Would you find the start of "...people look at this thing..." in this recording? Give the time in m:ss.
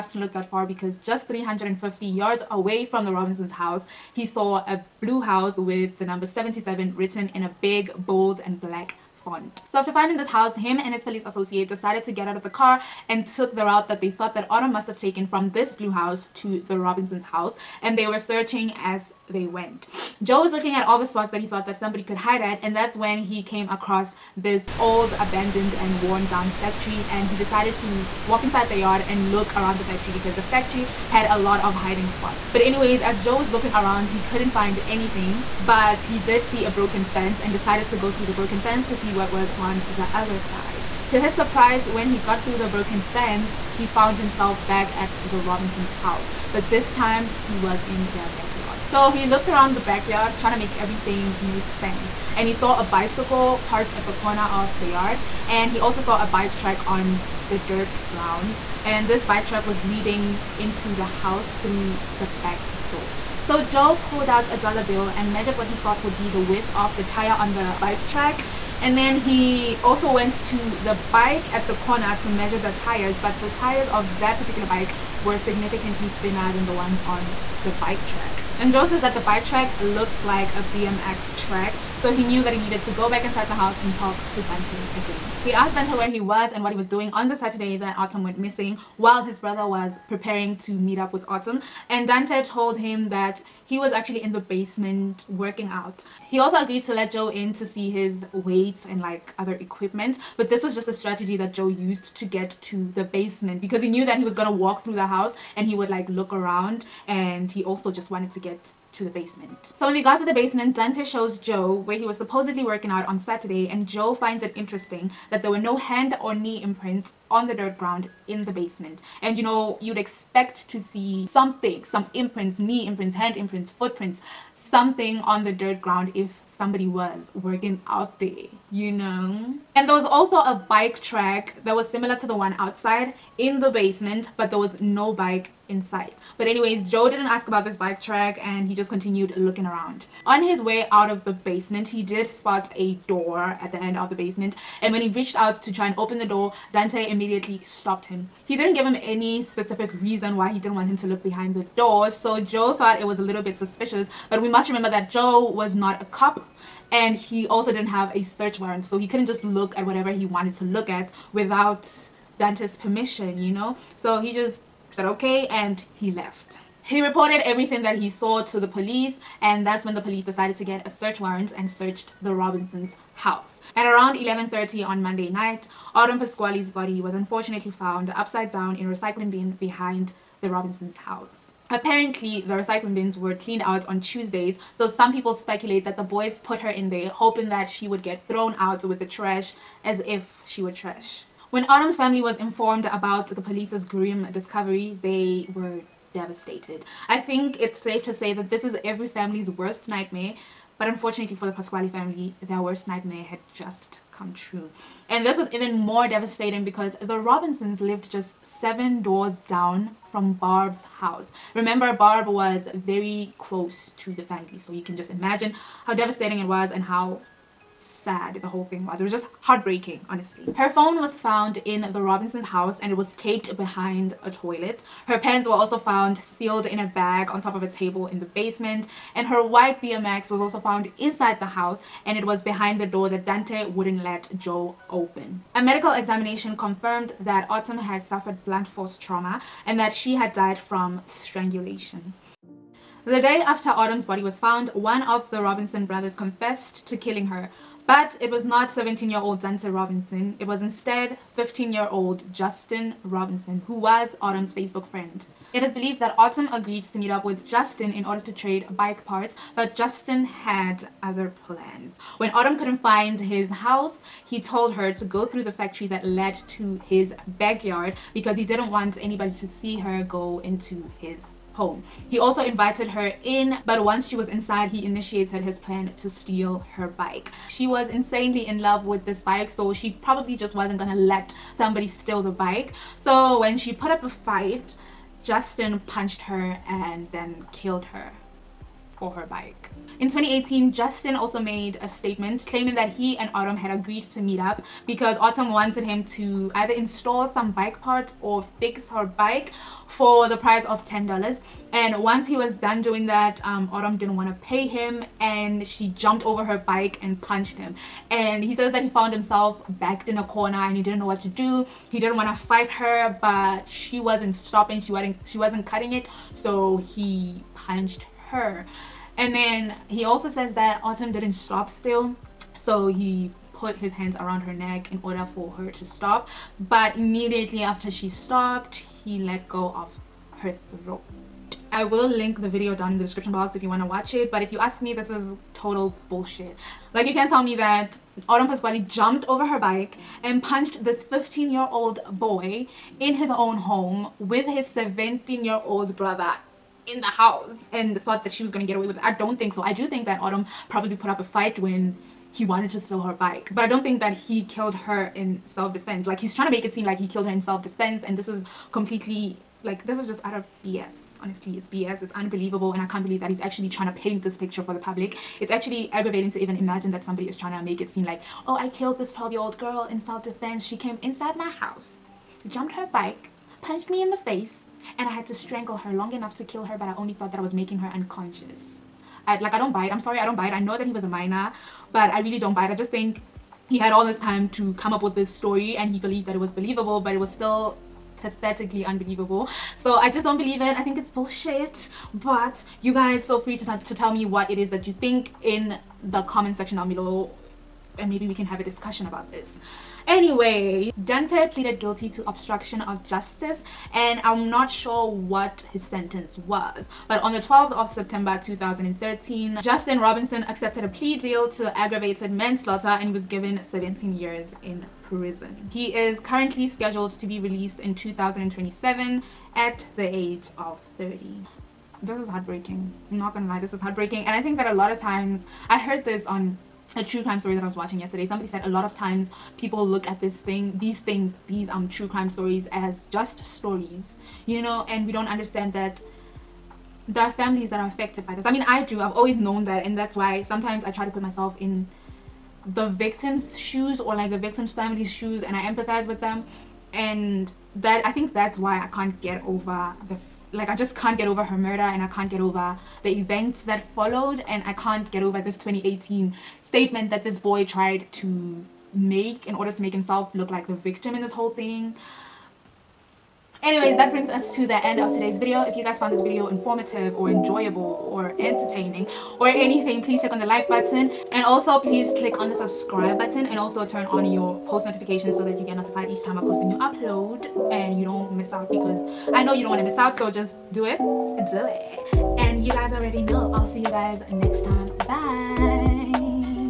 7:09.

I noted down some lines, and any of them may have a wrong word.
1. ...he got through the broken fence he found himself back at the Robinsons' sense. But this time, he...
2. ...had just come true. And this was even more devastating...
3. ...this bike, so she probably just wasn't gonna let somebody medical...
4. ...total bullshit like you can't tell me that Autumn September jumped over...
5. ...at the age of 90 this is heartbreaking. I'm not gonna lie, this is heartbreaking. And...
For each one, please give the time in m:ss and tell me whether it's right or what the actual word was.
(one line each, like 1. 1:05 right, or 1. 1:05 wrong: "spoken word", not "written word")
1. 0:42 wrong: "house", not "sense"
2. 3:23 right
3. 4:39 wrong: "steal", not "medical"
4. 5:35 wrong: "Pasquale", not "September"
5. 6:59 wrong: "30", not "90".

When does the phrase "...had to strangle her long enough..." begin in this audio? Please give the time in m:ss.
6:15.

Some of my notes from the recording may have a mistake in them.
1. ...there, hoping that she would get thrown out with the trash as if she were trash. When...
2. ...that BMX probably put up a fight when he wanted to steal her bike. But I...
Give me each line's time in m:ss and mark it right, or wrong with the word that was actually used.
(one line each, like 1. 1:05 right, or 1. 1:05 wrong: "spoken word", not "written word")
1. 3:06 right
2. 5:50 wrong: "Autumn", not "BMX".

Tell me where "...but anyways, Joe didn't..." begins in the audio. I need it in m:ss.
2:16.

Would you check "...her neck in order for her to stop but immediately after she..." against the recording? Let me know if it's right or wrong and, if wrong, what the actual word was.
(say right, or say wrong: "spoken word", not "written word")
right.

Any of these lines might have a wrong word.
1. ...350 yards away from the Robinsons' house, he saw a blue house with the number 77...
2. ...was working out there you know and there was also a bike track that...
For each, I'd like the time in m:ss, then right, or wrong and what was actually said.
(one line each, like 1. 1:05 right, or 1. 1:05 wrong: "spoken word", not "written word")
1. 0:01 right
2. 2:06 right.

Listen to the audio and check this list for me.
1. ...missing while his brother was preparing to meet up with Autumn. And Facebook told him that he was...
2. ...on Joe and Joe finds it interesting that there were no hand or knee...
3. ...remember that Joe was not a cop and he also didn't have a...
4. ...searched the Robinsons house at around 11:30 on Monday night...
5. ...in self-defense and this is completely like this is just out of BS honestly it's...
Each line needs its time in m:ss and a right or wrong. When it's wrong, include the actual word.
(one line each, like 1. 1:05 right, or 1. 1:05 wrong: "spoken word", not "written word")
1. 1:28 wrong: "Dante", not "Facebook"
2. 1:53 wrong: "Saturday", not "Joe"
3. 2:34 right
4. 2:51 right
5. 5:57 right.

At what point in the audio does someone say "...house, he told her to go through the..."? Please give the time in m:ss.
4:23.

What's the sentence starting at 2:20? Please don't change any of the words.
On his way out of the basement, he did spot a door at the end of the basement.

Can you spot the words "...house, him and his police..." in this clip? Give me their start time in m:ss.
0:10.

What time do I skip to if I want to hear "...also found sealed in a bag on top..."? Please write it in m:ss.
3:45.